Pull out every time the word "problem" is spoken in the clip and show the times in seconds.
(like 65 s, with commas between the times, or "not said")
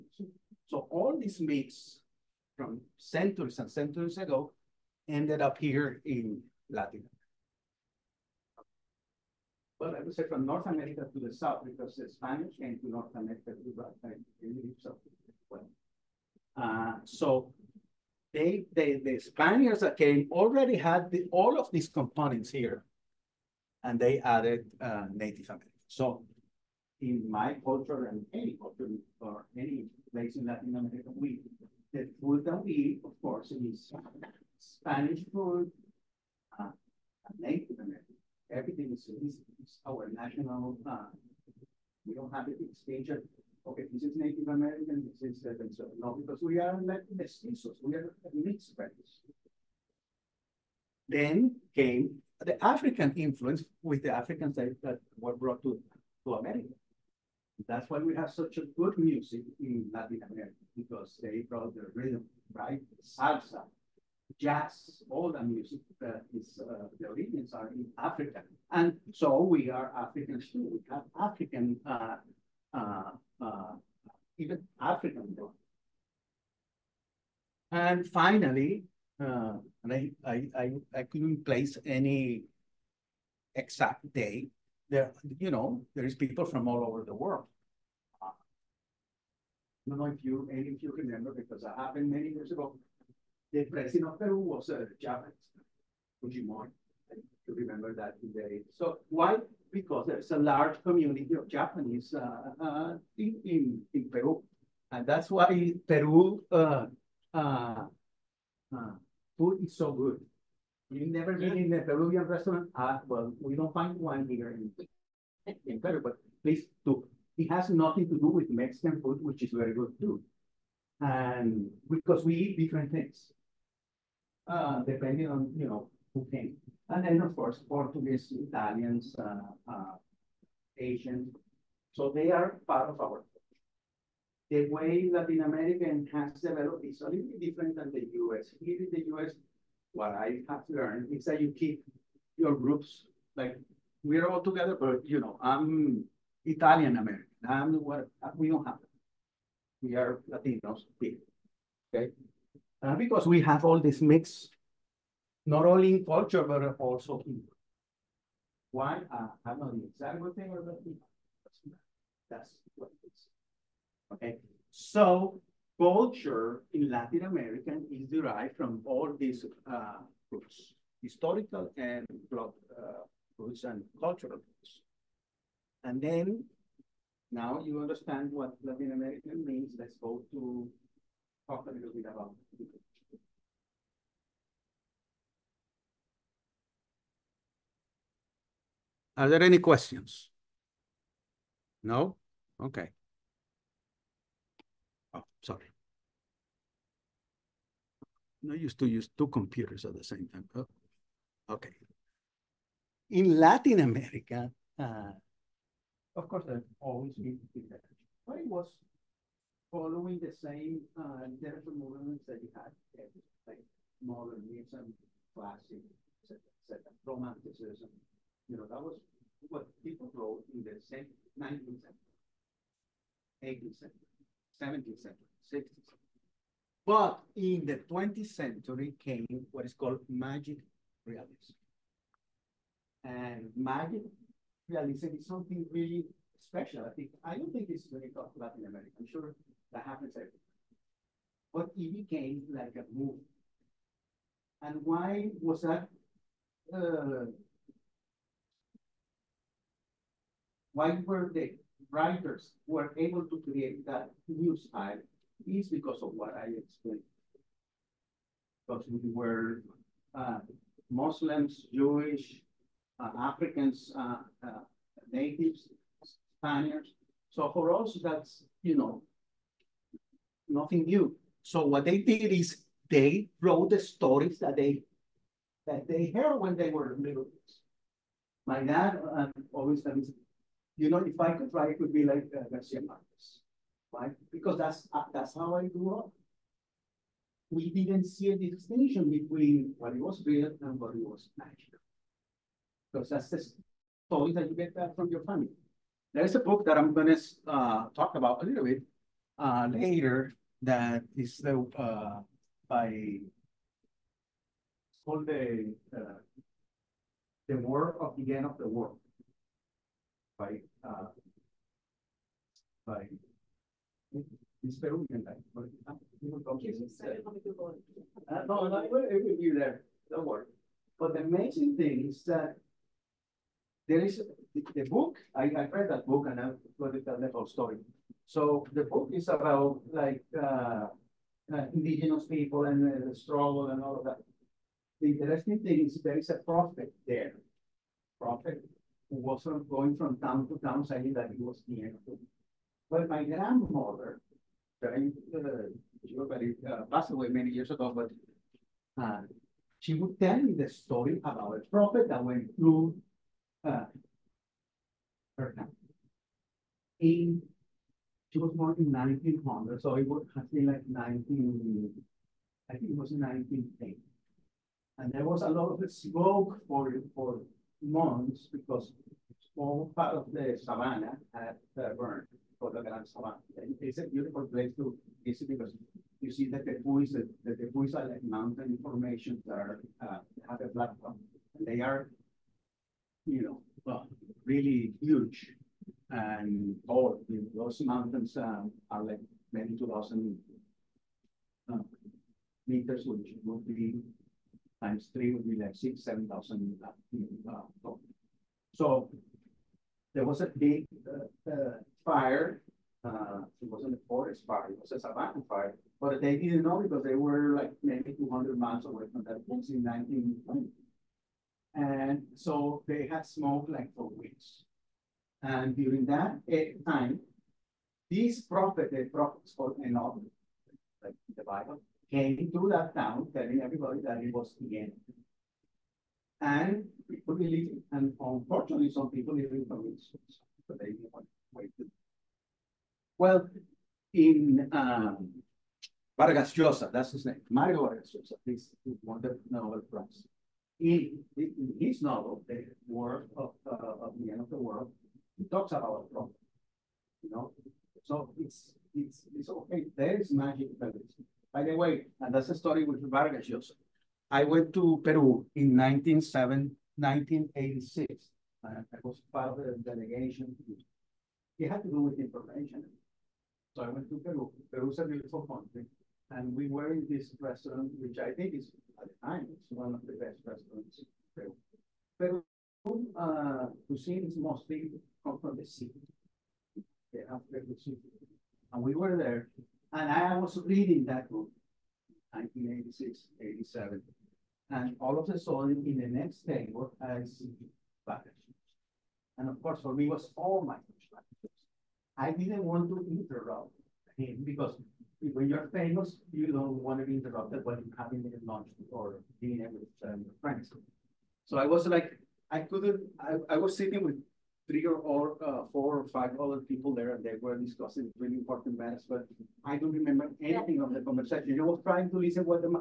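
446 s.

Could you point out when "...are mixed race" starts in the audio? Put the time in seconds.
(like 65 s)
47 s.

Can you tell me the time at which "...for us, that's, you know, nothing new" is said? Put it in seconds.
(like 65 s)
267 s.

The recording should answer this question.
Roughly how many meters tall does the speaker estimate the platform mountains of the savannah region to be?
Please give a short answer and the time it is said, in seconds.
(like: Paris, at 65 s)
2,000, at 389 s.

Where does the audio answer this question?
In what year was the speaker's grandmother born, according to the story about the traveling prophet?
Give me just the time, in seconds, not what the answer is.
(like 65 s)
358 s.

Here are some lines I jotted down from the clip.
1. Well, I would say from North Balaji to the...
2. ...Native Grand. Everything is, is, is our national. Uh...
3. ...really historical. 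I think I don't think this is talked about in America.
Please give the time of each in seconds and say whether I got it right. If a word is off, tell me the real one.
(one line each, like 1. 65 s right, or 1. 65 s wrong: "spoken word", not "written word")
1. 9 s wrong: "America", not "Balaji"
2. 37 s wrong: "American", not "Grand"
3. 235 s wrong: "special", not "historical".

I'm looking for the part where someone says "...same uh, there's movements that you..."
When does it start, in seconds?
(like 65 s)
210 s.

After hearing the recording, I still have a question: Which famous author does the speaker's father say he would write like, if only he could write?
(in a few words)
Garcia Marquez.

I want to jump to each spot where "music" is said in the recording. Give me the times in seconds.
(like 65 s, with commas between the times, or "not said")
58 s, 65 s.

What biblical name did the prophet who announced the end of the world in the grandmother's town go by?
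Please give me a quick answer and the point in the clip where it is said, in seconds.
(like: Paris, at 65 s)
Enoch, at 419 s.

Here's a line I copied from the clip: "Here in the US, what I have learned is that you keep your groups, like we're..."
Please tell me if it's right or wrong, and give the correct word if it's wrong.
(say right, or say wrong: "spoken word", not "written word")
right.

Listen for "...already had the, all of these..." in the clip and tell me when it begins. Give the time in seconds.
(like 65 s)
20 s.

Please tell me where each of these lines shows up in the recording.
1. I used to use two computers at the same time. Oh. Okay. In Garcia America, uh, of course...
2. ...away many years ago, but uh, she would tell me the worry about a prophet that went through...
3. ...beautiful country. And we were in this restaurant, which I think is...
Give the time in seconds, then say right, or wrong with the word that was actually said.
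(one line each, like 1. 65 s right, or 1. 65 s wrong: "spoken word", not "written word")
1. 198 s wrong: "Latin", not "Garcia"
2. 347 s wrong: "story", not "worry"
3. 465 s right.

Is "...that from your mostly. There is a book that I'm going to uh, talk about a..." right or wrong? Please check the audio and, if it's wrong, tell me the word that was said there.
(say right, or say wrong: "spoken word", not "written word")
wrong: "family", not "mostly".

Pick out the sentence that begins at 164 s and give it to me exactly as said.
Okay, so culture in Latin America is derived from all these uh, roots, historical and blood uh, roots and cultural roots.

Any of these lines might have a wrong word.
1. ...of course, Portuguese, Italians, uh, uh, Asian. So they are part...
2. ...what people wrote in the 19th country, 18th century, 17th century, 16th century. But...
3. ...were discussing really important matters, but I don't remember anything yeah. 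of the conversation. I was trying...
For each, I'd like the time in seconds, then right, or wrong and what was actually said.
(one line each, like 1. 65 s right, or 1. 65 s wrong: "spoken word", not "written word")
1. 127 s right
2. 219 s wrong: "century", not "country"
3. 507 s right.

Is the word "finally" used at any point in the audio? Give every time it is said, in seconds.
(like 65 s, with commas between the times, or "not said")
78 s.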